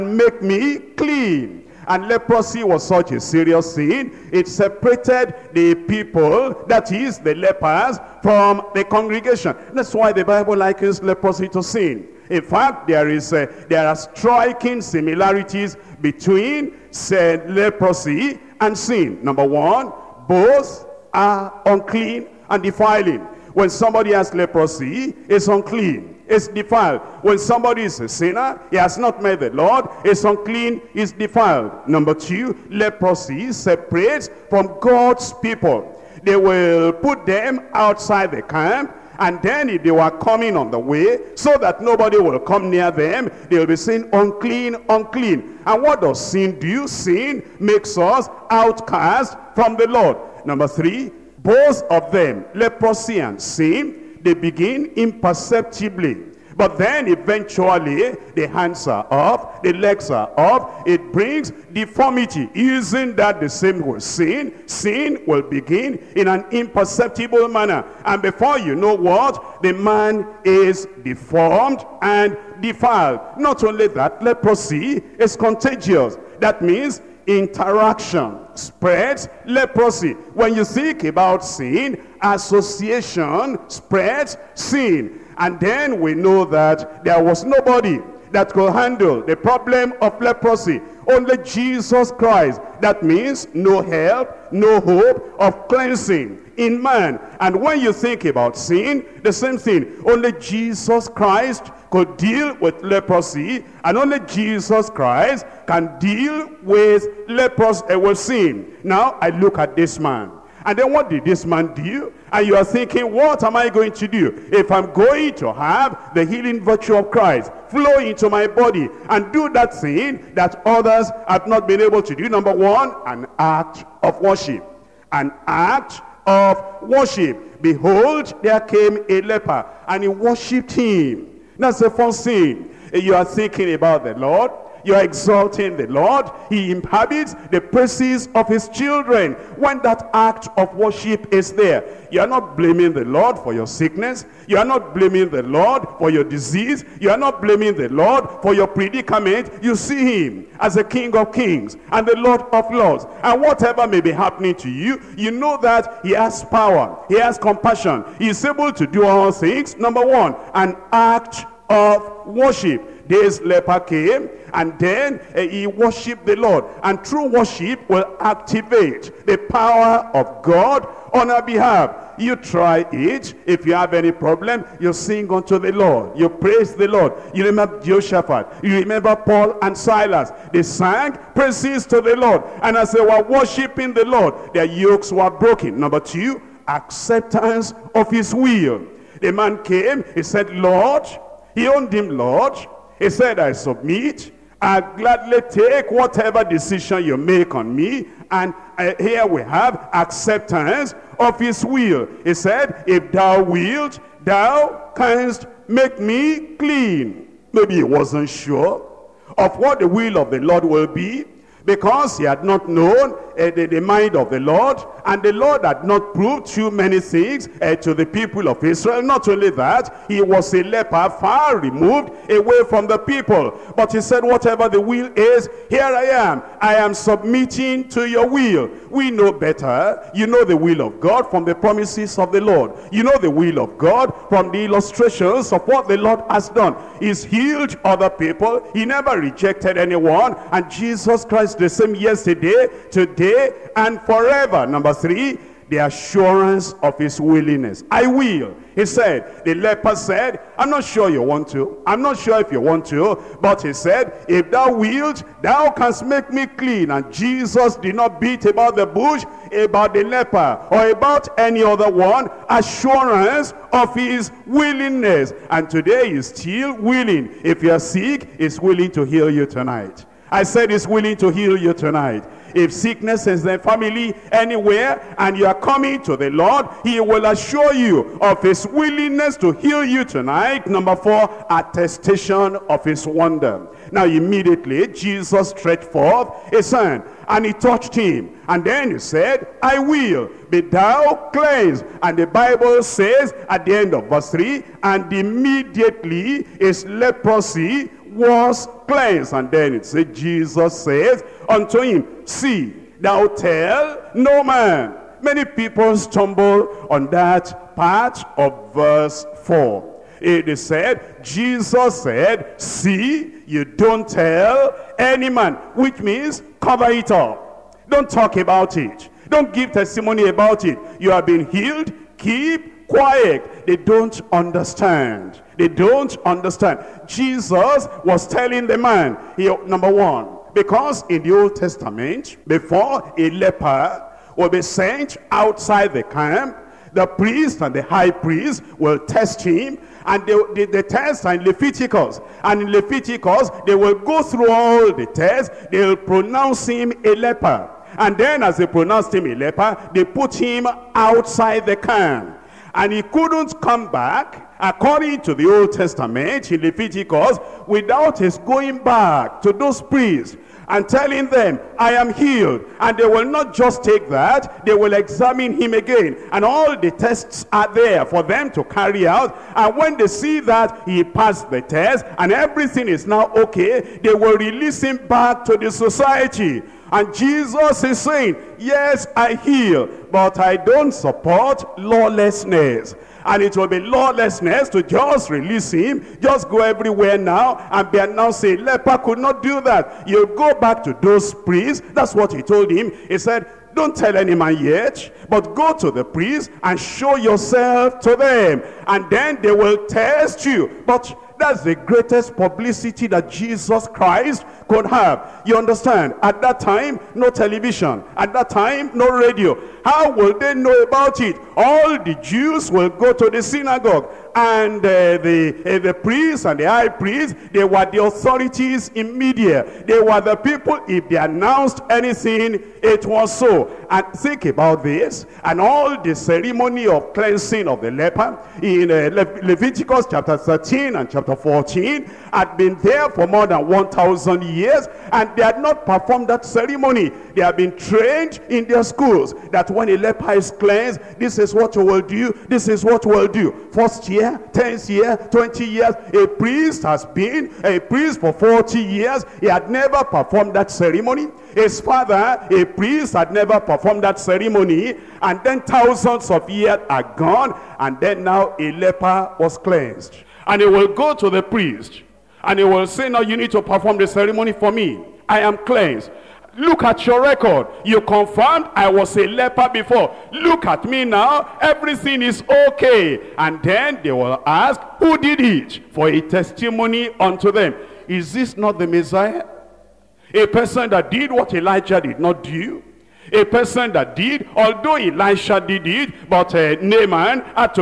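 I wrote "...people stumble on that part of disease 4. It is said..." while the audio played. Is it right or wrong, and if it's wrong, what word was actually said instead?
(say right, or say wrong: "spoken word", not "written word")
wrong: "verse", not "disease".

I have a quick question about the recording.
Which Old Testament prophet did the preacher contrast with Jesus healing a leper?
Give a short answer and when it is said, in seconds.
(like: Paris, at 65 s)
Elijah, at 481 s.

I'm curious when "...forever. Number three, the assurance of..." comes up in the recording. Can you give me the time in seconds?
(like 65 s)
244 s.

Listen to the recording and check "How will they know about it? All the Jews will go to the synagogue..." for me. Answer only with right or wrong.
right.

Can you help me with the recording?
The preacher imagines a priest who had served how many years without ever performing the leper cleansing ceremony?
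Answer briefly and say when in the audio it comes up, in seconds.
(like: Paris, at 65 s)
40 years, at 448 s.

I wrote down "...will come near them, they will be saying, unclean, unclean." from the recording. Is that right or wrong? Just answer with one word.
right.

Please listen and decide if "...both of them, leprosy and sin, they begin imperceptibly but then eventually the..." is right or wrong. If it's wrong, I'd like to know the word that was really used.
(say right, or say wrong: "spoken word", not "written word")
right.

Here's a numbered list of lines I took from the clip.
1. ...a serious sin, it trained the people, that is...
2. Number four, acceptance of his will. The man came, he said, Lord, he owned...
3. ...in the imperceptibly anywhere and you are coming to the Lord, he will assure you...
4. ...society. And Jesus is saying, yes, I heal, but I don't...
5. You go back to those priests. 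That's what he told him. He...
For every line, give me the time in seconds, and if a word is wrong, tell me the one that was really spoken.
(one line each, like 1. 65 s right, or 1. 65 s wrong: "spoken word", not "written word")
1. 3 s wrong: "separated", not "trained"
2. 185 s wrong: "two", not "four"
3. 273 s wrong: "family", not "imperceptibly"
4. 375 s right
5. 390 s right.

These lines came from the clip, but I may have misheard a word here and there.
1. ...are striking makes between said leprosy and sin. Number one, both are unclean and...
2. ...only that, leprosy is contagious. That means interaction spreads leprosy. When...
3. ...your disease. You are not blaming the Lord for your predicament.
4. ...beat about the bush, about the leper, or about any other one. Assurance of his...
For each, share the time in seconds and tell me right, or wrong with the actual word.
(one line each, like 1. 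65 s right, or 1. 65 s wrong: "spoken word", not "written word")
1. 13 s wrong: "similarities", not "makes"
2. 73 s right
3. 146 s right
4. 258 s right.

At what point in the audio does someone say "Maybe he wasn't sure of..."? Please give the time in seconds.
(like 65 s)
207 s.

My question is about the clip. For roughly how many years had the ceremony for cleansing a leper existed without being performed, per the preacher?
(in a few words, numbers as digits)
More than 1,000 years.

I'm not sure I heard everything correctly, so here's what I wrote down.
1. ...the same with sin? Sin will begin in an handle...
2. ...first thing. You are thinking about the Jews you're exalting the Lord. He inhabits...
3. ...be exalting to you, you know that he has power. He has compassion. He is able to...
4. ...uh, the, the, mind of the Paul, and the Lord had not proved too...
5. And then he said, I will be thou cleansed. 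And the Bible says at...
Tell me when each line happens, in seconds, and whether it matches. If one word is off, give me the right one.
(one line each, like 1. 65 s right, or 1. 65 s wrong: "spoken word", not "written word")
1. 63 s wrong: "imperceptible", not "handle"
2. 131 s wrong: "Lord", not "Jews"
3. 154 s wrong: "happening", not "exalting"
4. 213 s wrong: "Lord", not "Paul"
5. 288 s right.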